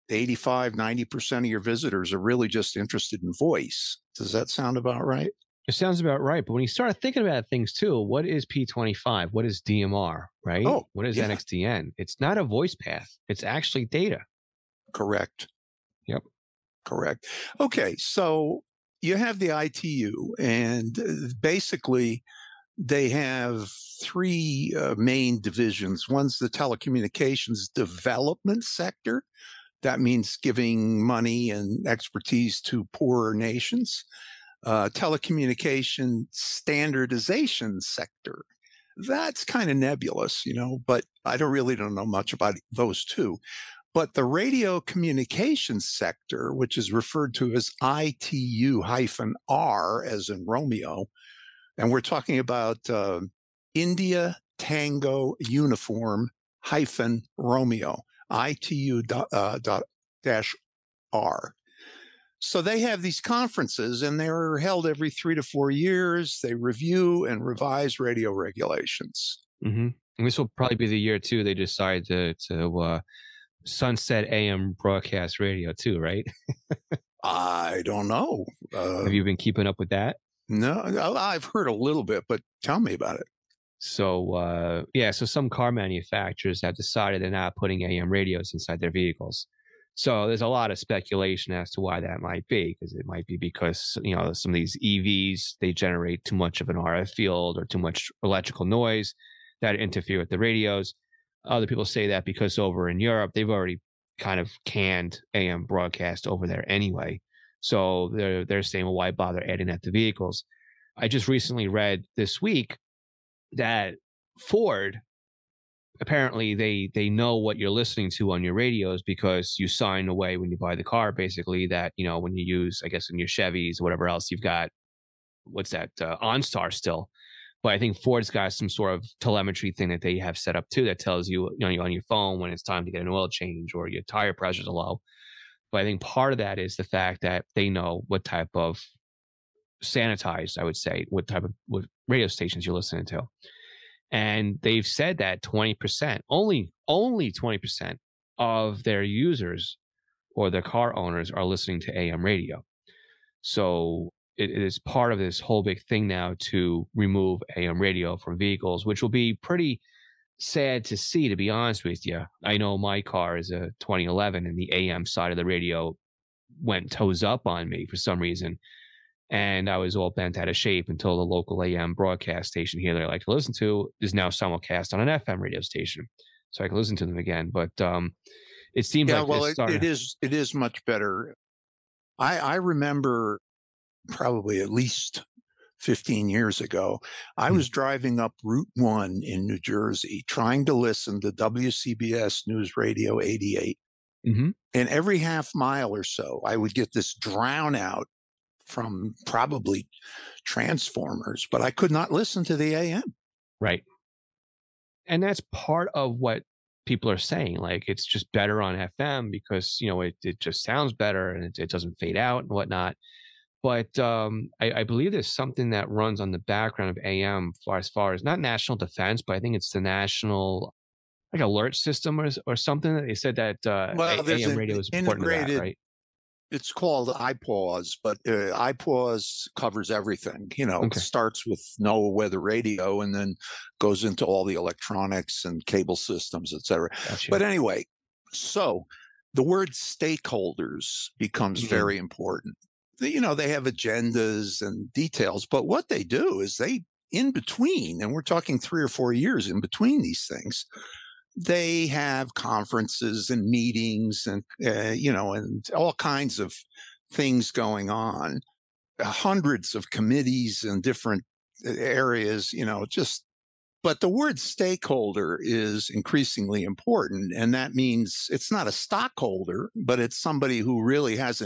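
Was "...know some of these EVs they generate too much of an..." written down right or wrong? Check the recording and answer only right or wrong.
right.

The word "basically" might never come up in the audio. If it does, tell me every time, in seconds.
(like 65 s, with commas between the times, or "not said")
21 s, 121 s.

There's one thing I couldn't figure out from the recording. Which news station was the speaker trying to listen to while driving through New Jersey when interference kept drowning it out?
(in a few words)
WCBS News Radio 88.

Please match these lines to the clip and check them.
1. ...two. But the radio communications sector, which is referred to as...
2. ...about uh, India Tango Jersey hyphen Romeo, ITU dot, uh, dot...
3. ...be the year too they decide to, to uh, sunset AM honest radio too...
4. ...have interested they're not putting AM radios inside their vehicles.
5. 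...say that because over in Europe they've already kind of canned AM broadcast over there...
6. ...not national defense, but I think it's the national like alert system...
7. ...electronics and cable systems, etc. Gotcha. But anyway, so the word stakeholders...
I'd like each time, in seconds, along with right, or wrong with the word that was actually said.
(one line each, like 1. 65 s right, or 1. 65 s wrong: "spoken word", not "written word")
1. 43 s right
2. 52 s wrong: "Uniform", not "Jersey"
3. 70 s wrong: "broadcast", not "honest"
4. 86 s wrong: "decided", not "interested"
5. 101 s right
6. 218 s right
7. 234 s right.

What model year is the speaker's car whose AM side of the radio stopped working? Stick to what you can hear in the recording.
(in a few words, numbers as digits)
2011.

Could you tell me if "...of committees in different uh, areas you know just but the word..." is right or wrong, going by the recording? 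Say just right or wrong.
right.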